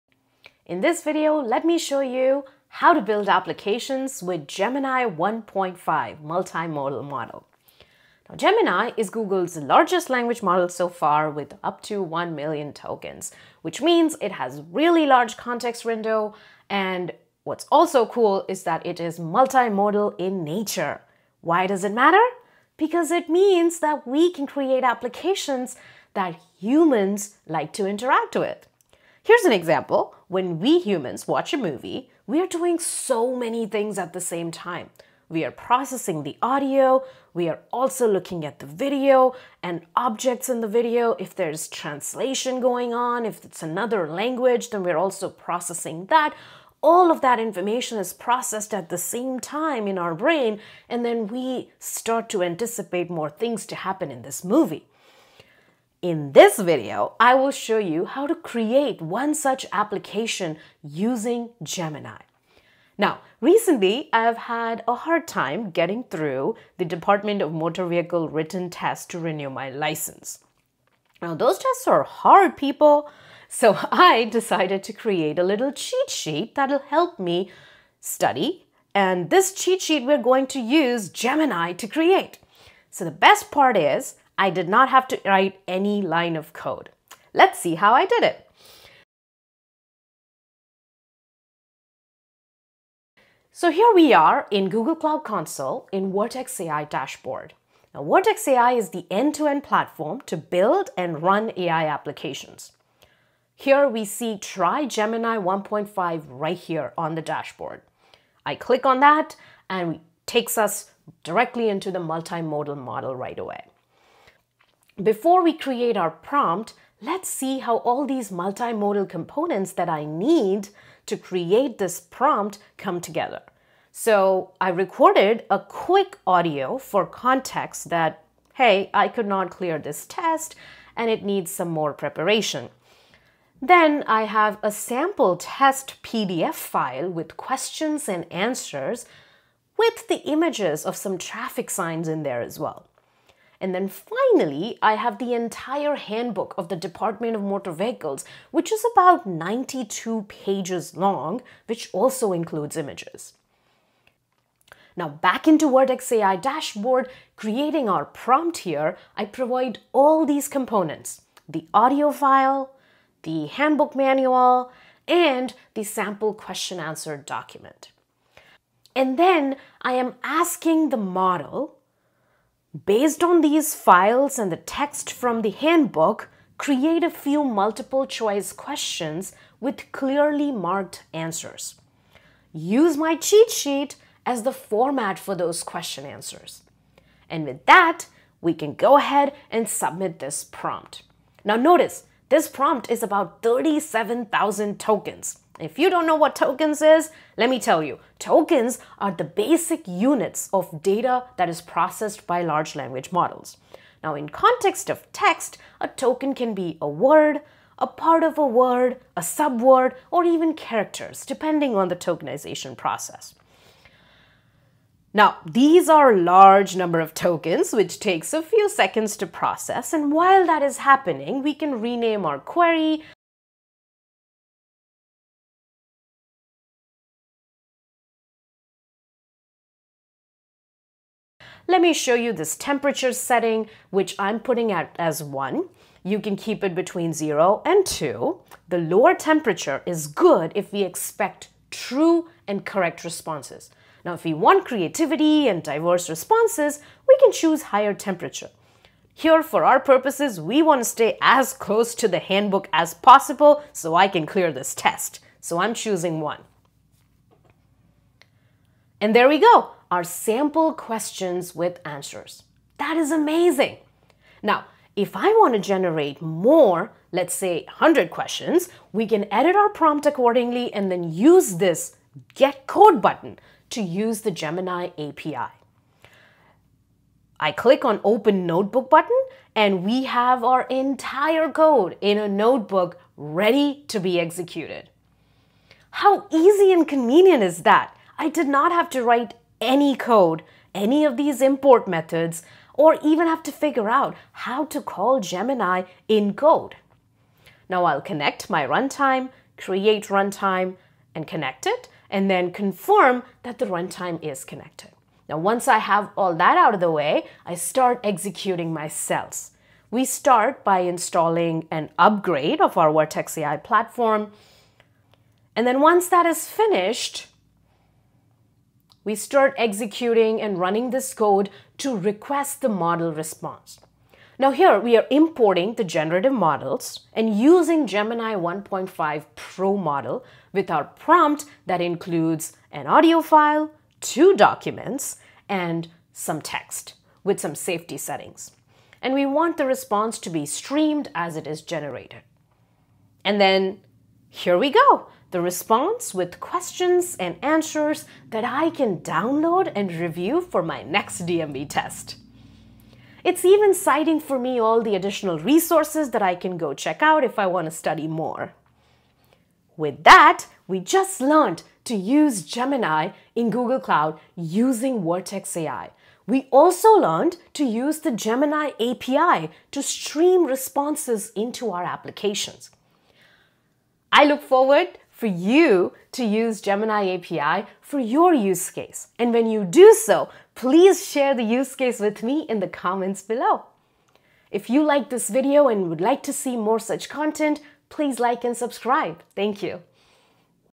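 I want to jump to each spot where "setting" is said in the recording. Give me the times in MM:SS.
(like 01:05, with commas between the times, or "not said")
03:53, 05:37.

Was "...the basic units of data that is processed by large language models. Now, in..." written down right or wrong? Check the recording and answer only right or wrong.
right.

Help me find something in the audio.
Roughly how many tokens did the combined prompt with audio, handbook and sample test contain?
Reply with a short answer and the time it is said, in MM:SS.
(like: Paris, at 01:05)
37,000, at 03:13.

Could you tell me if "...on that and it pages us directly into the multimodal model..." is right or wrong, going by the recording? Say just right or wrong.
wrong.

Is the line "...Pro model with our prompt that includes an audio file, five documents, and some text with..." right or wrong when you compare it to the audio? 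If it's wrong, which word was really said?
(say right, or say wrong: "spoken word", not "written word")
wrong: "two", not "five".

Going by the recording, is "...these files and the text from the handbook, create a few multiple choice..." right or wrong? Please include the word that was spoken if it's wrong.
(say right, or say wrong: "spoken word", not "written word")
right.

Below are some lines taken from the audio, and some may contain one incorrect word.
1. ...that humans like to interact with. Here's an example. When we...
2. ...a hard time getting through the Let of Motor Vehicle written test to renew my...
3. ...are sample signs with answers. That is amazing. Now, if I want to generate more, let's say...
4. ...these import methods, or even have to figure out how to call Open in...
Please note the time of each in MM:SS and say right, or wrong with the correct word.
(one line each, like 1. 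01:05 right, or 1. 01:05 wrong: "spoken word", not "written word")
1. 00:26 right
2. 01:04 wrong: "Department", not "Let"
3. 04:19 wrong: "questions", not "signs"
4. 04:51 wrong: "Gemini", not "Open".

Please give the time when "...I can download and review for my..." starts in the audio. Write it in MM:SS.
05:48.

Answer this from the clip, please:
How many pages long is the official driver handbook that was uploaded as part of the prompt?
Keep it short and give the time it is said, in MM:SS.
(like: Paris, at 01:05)
92, at 02:29.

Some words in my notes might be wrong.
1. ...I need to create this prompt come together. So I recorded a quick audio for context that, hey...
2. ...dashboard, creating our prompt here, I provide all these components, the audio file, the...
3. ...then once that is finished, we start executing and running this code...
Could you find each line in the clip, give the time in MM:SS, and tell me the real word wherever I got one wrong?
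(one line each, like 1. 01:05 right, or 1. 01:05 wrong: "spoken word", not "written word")
1. 01:59 right
2. 02:36 right
3. 05:15 right.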